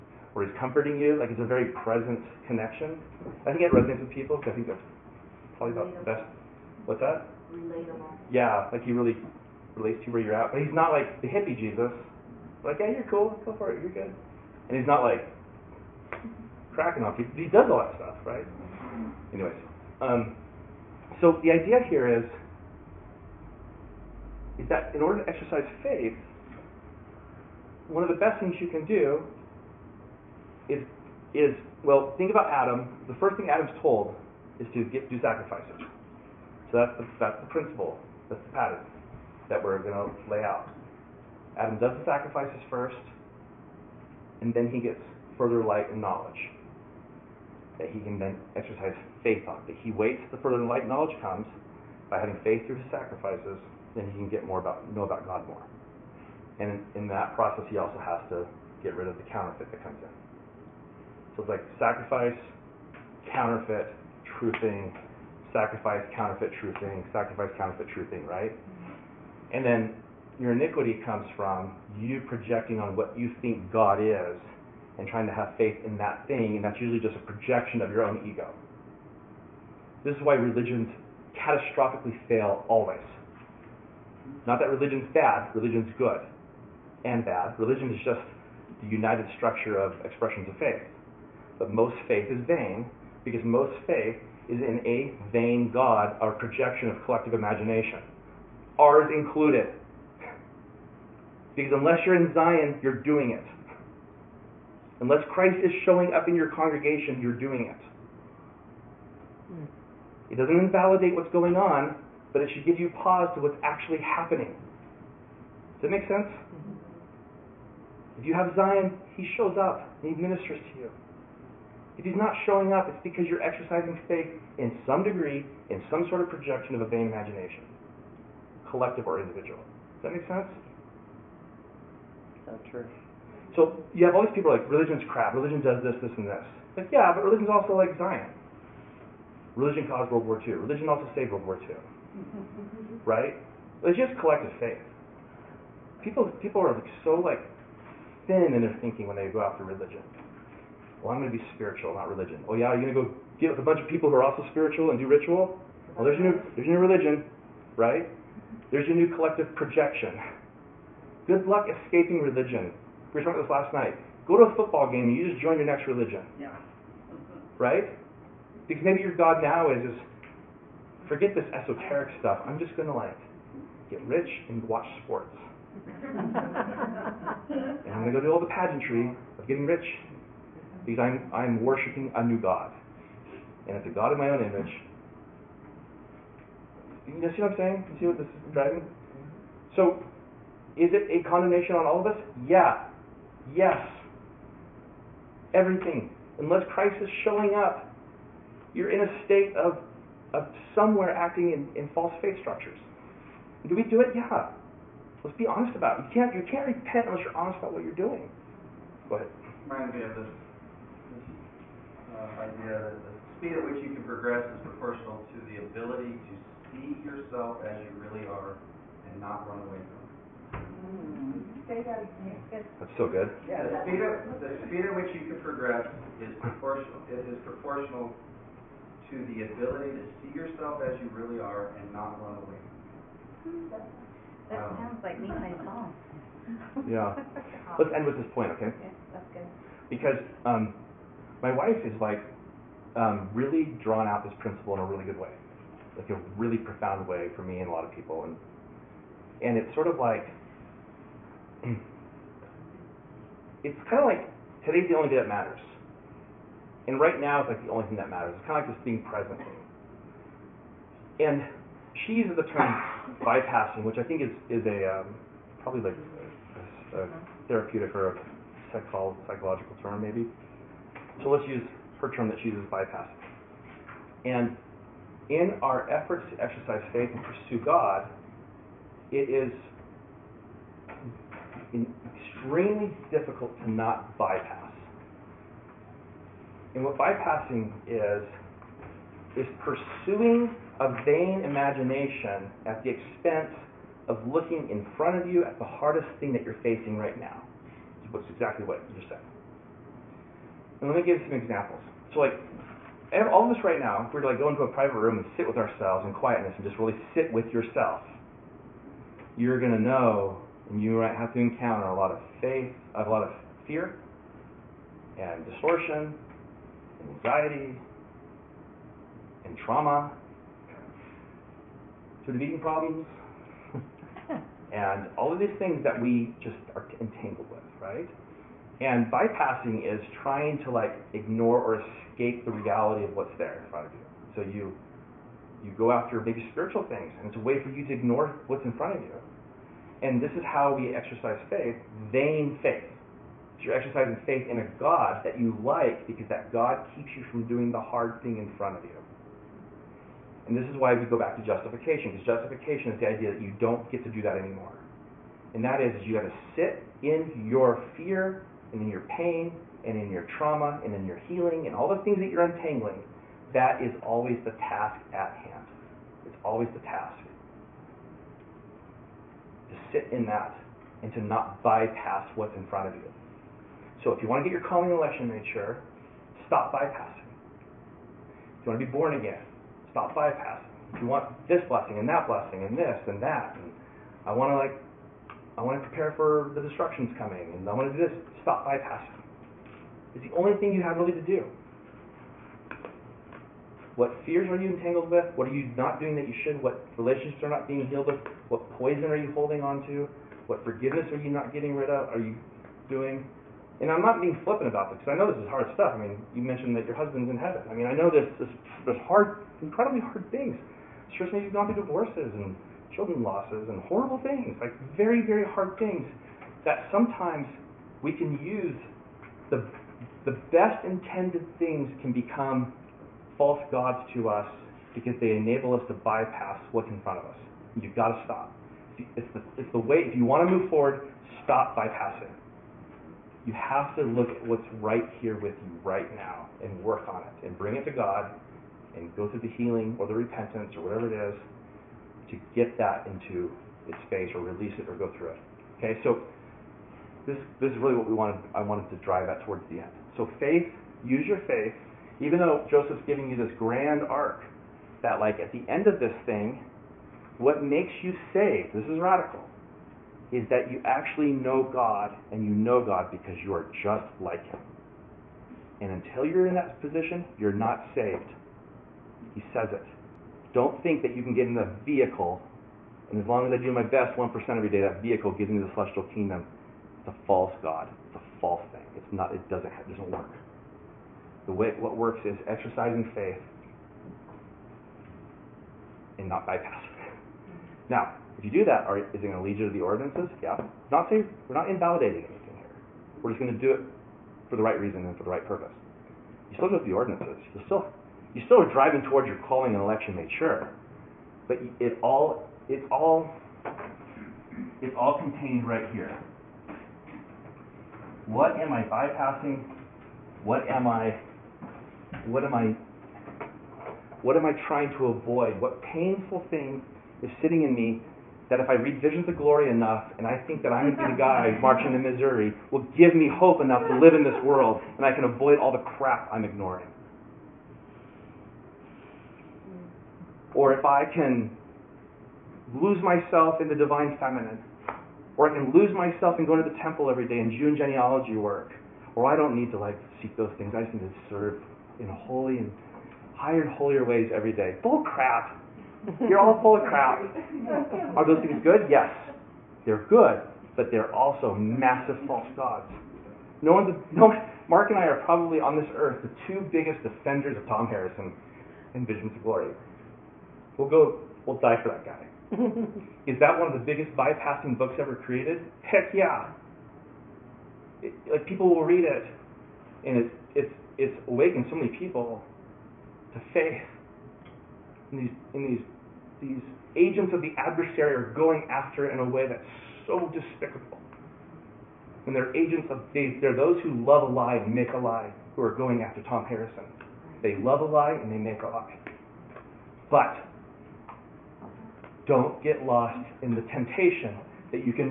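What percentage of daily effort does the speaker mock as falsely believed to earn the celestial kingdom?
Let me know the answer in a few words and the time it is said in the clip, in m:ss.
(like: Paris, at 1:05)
1%, at 7:54.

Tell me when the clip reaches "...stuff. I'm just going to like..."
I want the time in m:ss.
2:52.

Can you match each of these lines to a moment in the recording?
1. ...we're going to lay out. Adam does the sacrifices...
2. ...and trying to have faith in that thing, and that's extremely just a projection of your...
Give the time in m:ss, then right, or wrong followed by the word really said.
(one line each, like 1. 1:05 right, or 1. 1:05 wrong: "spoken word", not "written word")
1. 0:39 right
2. 1:14 wrong: "usually", not "extremely".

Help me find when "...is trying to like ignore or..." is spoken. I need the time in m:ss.
5:29.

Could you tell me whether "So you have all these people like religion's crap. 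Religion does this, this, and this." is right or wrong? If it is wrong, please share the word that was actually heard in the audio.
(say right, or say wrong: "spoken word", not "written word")
right.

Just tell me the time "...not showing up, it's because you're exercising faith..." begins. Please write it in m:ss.
2:02.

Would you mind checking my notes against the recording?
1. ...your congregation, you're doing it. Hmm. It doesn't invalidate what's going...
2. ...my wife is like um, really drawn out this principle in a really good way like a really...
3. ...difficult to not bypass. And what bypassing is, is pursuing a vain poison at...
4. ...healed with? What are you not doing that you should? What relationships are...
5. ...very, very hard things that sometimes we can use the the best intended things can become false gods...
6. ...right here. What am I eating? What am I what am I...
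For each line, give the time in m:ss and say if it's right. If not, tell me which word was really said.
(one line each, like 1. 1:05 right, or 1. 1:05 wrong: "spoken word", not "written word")
1. 1:46 right
2. 4:01 right
3. 4:43 wrong: "imagination", not "poison"
4. 6:34 wrong: "entangled", not "healed"
5. 6:54 right
6. 8:25 wrong: "bypassing", not "eating".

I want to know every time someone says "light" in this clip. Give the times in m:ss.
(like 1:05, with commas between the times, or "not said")
0:45, 0:50.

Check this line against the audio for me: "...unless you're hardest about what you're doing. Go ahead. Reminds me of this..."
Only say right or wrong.
wrong.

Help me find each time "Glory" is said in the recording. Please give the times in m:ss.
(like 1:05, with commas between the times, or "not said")
8:39, 9:19.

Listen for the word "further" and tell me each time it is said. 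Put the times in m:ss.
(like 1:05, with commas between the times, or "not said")
0:45, 0:50.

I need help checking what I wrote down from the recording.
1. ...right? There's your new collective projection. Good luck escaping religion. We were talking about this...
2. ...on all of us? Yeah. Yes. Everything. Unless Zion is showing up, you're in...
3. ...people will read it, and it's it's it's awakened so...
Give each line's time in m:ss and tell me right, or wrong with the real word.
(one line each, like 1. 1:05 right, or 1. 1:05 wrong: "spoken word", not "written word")
1. 2:37 right
2. 3:11 wrong: "Christ", not "Zion"
3. 9:28 right.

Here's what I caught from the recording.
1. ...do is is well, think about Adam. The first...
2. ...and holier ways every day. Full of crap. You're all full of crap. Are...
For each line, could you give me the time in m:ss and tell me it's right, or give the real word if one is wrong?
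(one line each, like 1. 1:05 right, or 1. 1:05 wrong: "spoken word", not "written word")
1. 0:28 right
2. 9:03 right.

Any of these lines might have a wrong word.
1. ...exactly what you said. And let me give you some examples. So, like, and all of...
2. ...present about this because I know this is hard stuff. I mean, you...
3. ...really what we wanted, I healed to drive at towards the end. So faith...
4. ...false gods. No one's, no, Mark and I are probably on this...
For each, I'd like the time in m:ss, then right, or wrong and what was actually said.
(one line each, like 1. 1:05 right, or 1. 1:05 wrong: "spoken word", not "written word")
1. 4:58 right
2. 6:44 wrong: "flippant", not "present"
3. 7:27 wrong: "wanted", not "healed"
4. 9:12 right.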